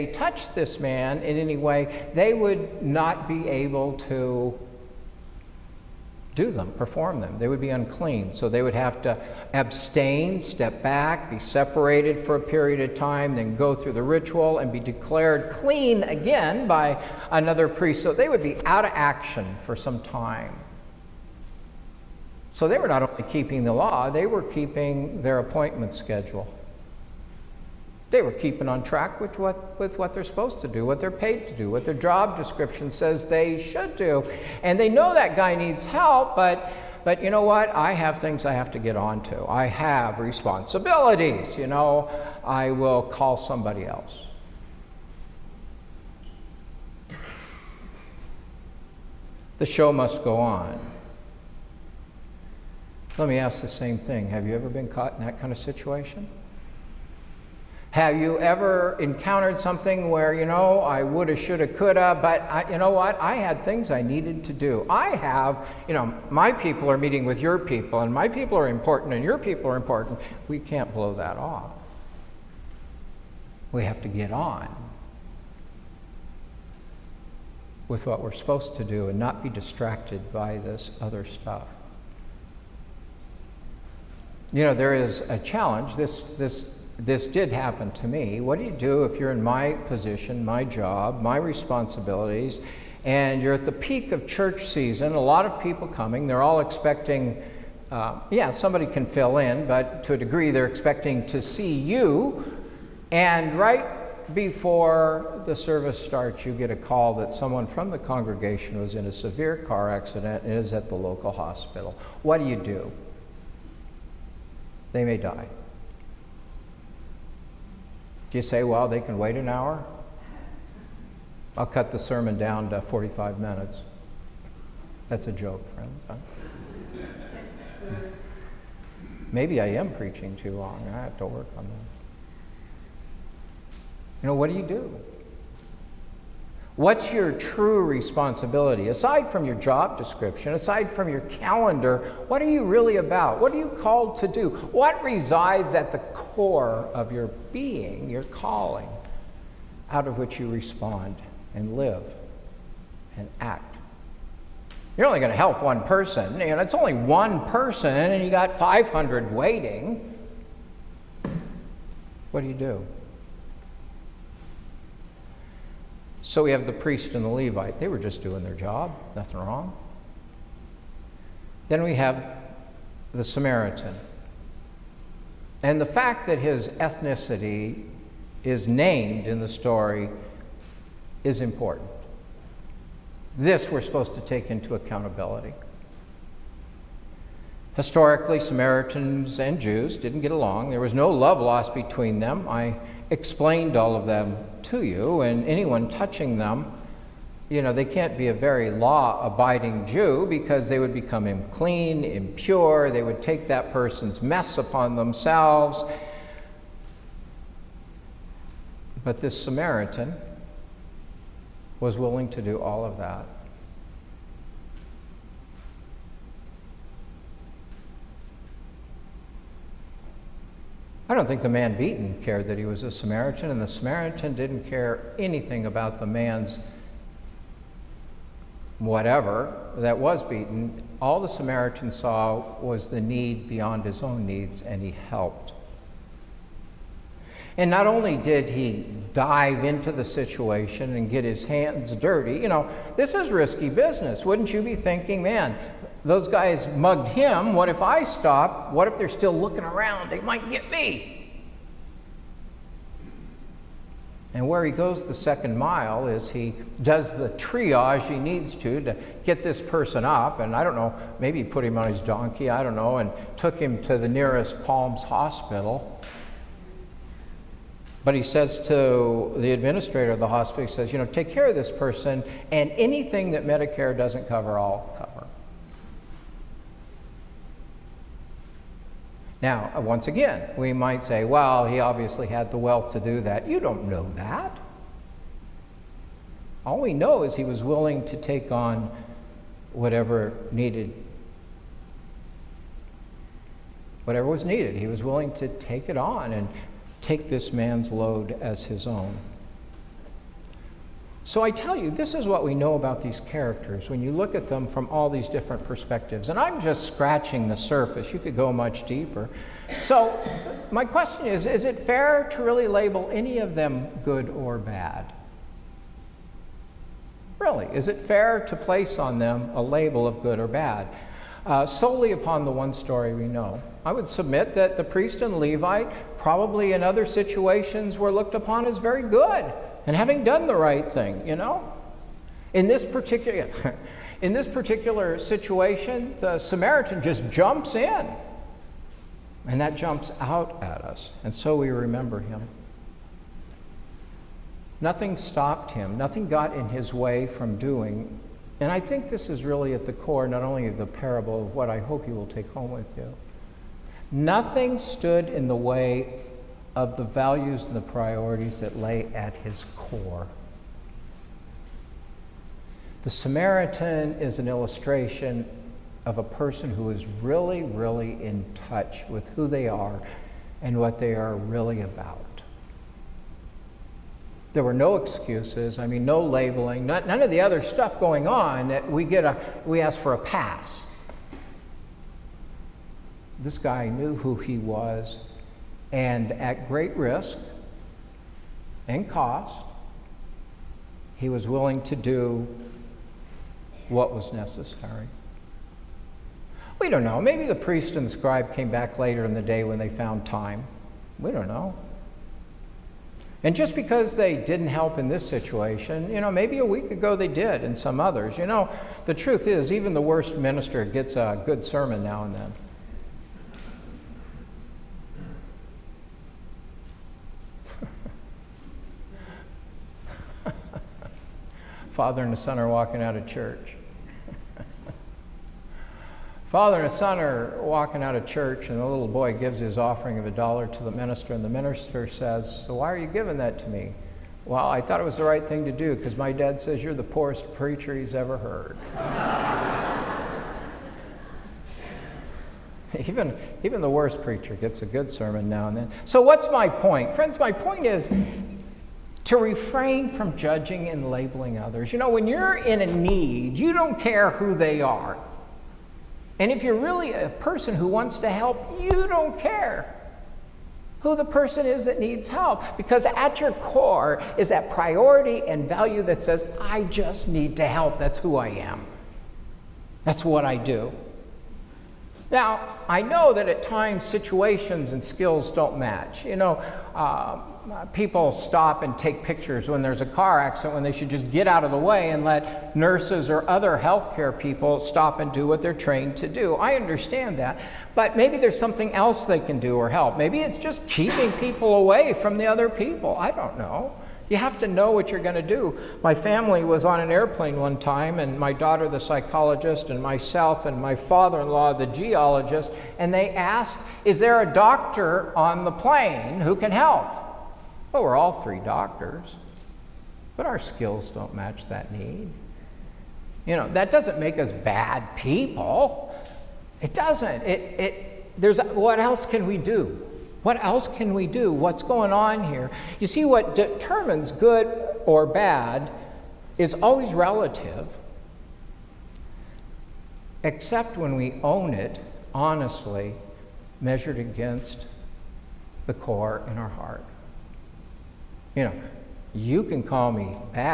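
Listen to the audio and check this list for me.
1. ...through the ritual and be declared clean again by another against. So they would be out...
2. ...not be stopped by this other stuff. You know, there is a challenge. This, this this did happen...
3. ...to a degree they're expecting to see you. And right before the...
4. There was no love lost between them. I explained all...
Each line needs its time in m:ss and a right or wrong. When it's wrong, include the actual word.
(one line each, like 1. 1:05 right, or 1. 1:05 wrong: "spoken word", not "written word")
1. 0:13 wrong: "priest", not "against"
2. 1:19 wrong: "distracted", not "stopped"
3. 1:40 right
4. 3:10 right.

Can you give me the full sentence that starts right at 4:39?
Now, once again, we might say, well, he obviously had the wealth to do that.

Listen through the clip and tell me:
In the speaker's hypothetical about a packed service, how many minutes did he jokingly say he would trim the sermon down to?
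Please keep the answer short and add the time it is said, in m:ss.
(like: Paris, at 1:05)
45, at 2:02.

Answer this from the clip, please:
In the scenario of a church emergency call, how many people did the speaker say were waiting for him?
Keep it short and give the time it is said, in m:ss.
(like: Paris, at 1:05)
500, at 2:38.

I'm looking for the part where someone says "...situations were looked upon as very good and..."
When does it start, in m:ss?
5:27.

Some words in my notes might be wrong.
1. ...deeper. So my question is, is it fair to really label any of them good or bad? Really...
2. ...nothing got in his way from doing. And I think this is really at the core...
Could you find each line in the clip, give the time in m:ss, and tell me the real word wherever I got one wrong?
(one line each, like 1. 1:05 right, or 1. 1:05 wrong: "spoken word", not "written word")
1. 5:08 right
2. 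5:45 right.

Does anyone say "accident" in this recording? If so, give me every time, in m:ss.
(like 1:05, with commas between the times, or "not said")
1:49, 8:00.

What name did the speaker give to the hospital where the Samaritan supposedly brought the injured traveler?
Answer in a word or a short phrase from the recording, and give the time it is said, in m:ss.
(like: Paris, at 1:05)
Palms Hospital, at 4:24.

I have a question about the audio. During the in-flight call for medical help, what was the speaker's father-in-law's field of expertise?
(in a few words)
geologist.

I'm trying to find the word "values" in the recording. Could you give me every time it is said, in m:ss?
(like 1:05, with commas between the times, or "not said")
5:57, 7:45.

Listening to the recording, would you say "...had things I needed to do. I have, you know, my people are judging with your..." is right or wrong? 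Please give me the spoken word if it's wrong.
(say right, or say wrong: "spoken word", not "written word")
wrong: "meeting", not "judging".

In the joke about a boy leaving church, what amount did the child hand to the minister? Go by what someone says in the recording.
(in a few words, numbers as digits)
a dollar.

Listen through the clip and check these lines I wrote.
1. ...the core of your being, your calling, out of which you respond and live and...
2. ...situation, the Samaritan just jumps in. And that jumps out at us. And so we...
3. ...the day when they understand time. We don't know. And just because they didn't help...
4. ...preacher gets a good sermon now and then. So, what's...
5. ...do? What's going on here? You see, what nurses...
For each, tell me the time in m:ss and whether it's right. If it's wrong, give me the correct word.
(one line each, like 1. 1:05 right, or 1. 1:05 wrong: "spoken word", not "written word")
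1. 2:25 right
2. 5:35 right
3. 6:39 wrong: "found", not "understand"
4. 7:24 right
5. 8:41 wrong: "determines", not "nurses".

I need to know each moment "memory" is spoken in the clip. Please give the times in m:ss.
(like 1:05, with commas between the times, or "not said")
not said.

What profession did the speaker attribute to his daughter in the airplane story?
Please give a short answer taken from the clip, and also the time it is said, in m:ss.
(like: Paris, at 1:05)
psychologist, at 8:18.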